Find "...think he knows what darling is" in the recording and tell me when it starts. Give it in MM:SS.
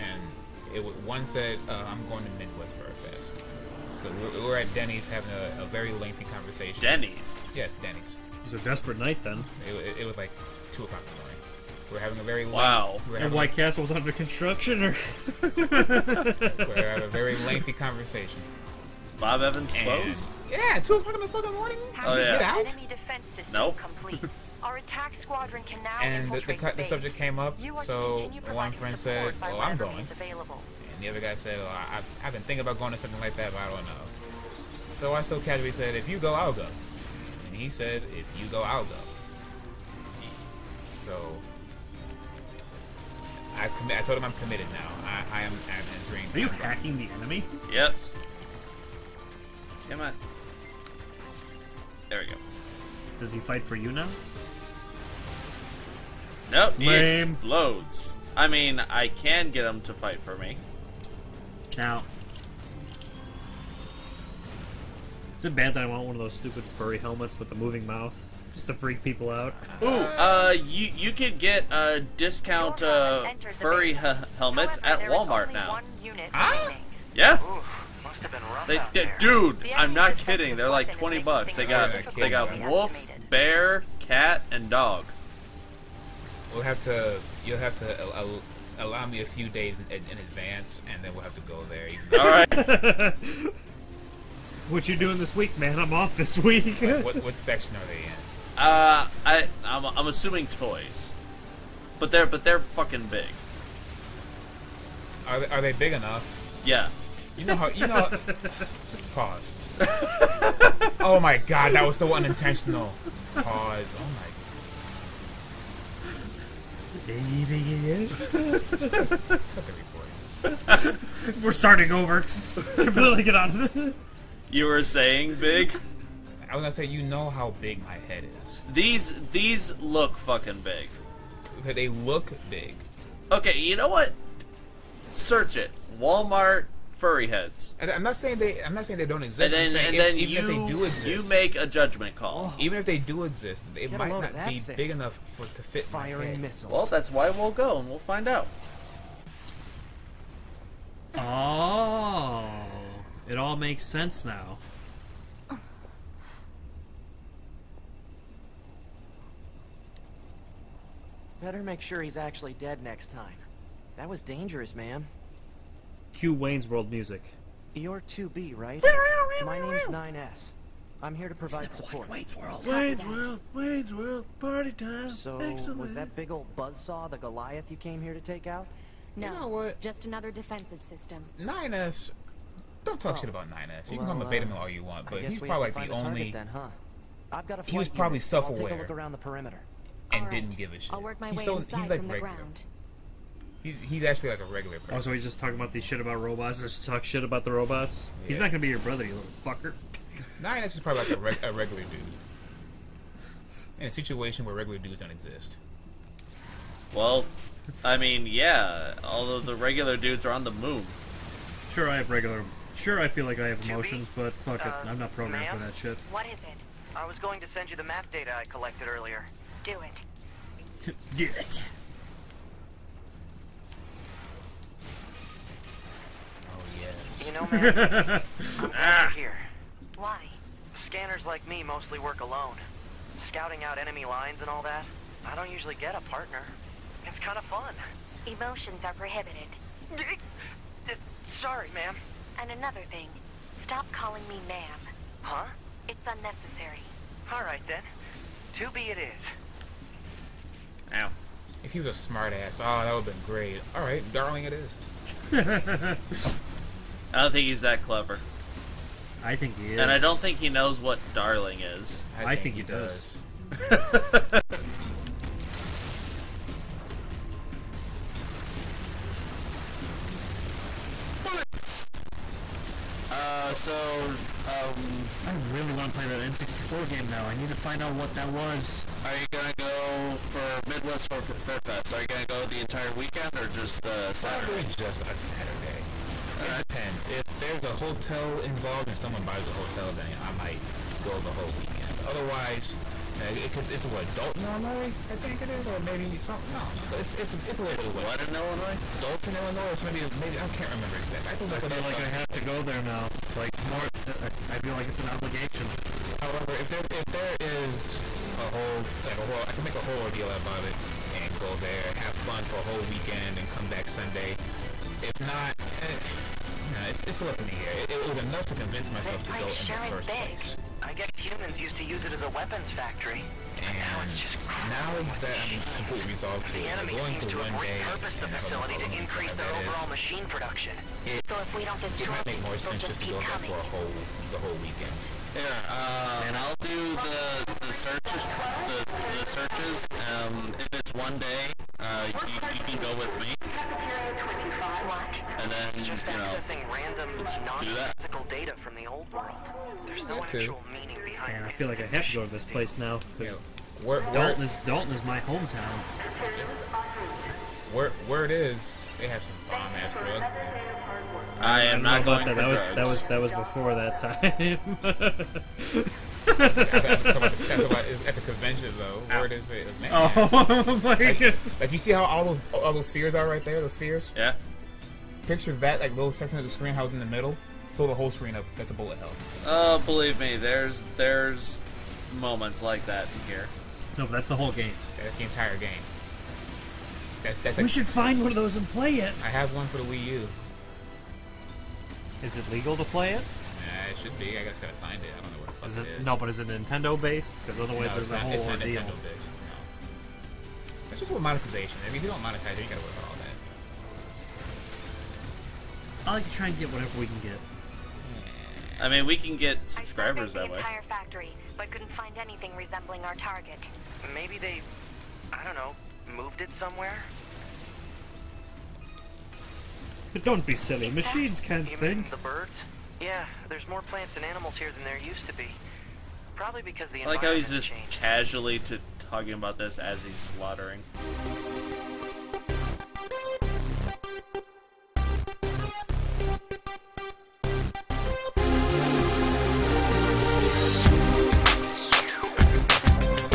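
04:20.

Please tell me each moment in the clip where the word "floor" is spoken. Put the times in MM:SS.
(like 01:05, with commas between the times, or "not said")
not said.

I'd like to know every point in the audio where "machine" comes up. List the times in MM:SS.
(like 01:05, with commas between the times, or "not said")
05:29, 07:00.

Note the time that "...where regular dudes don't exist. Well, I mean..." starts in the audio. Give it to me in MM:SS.
03:24.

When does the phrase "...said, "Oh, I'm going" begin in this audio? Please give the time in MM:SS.
00:28.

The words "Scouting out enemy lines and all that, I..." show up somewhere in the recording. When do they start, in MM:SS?
03:53.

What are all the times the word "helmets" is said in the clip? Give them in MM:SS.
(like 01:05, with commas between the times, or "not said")
01:06, 01:14.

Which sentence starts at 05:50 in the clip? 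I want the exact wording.
actual meaning behind yeah, I feel like I have to go to this place now.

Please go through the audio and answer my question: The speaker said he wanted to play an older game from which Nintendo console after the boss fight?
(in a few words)
N64.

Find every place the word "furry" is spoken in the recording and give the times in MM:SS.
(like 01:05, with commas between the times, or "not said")
01:06, 01:13, 02:17.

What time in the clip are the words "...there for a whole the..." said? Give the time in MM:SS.
05:33.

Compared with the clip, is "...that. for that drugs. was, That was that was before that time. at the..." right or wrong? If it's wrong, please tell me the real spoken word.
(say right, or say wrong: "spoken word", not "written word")
right.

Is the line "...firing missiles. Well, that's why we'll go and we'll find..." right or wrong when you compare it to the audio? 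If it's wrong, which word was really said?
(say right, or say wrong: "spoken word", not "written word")
right.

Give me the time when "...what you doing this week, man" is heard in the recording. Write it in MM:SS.
01:34.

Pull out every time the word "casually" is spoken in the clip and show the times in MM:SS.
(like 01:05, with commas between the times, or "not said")
00:35, 07:07.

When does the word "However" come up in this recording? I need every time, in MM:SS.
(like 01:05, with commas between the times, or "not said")
01:14, 05:06.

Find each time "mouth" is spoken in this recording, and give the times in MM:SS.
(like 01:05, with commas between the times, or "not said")
01:07.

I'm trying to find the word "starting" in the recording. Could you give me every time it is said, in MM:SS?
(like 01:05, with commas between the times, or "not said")
02:01.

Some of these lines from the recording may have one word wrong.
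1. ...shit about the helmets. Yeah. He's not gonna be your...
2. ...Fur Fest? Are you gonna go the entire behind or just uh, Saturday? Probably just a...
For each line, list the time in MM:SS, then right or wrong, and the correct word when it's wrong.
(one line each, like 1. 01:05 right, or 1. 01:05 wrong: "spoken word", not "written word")
1. 03:17 wrong: "robots", not "helmets"
2. 04:41 wrong: "weekend", not "behind".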